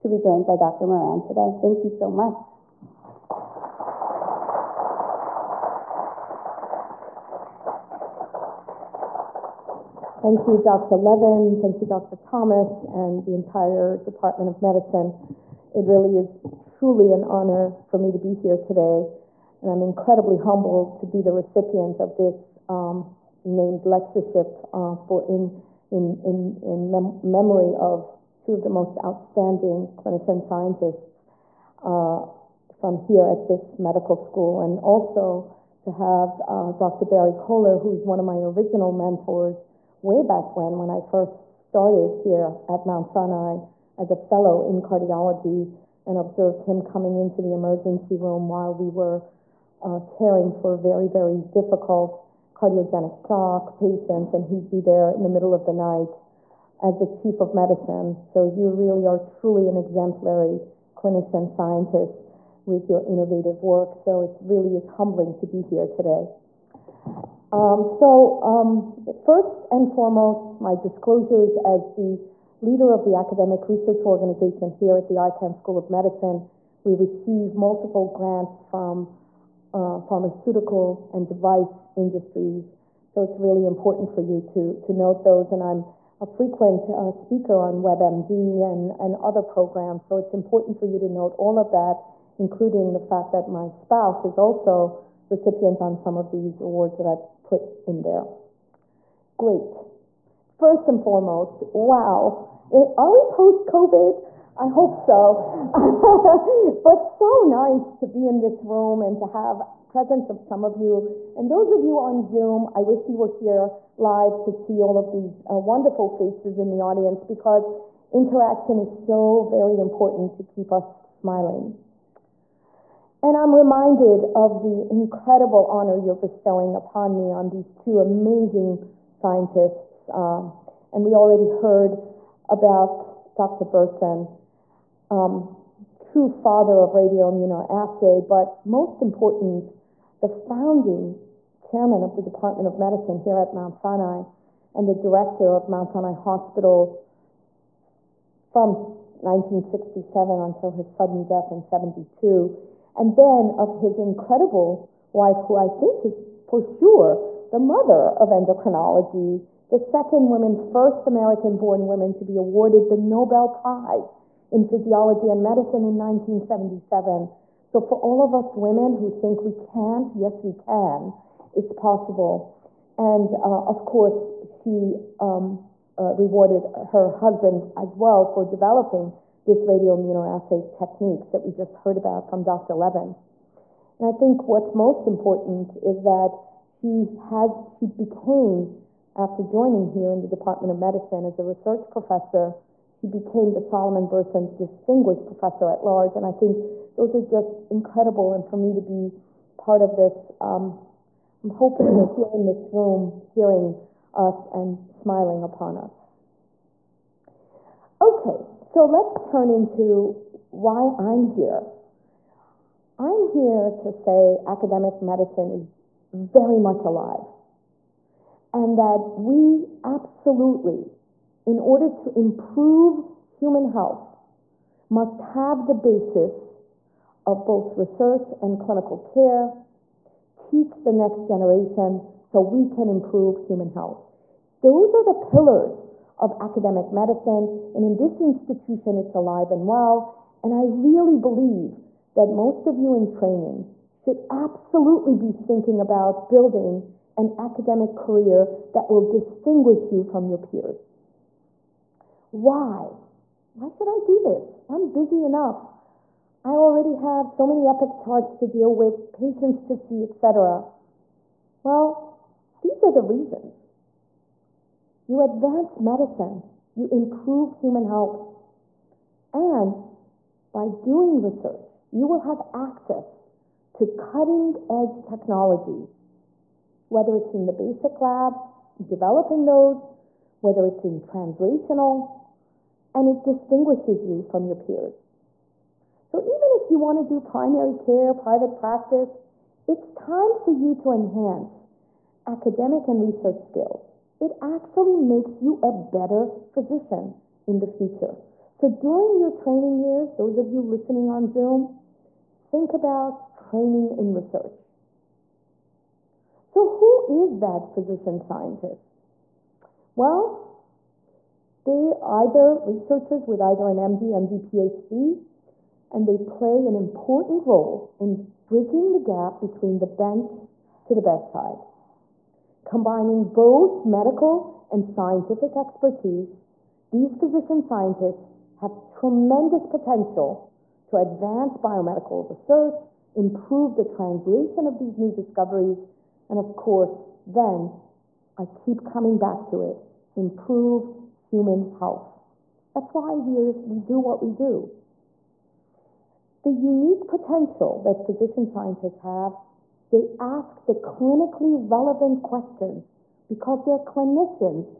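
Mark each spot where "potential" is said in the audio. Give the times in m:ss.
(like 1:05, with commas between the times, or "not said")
5:29, 5:47.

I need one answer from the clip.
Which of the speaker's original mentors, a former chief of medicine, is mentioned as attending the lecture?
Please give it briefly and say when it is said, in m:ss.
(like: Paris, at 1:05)
Dr. Barry Coller, at 0:36.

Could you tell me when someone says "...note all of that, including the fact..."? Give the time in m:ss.
1:31.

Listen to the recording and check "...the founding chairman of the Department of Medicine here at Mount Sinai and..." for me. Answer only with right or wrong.
right.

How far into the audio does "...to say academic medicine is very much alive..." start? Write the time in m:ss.
3:33.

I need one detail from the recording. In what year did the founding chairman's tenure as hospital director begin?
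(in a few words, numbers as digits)
1967.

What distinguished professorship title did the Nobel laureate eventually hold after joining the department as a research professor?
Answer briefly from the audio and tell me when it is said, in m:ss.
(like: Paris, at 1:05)
Solomon Berson Distinguished Professor at Large, at 3:13.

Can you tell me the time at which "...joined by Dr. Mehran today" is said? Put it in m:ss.
0:00.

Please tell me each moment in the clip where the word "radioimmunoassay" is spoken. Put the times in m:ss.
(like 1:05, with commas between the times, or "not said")
2:16, 2:59.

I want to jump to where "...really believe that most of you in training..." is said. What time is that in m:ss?
4:00.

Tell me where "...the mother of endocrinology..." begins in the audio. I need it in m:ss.
2:37.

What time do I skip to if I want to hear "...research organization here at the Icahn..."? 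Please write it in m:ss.
1:13.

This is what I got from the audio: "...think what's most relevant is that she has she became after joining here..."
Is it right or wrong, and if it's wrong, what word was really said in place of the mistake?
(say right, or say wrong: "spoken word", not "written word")
wrong: "important", not "relevant".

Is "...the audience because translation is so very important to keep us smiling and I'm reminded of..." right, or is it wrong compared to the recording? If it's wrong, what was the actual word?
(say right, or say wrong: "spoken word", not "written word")
wrong: "interaction", not "translation".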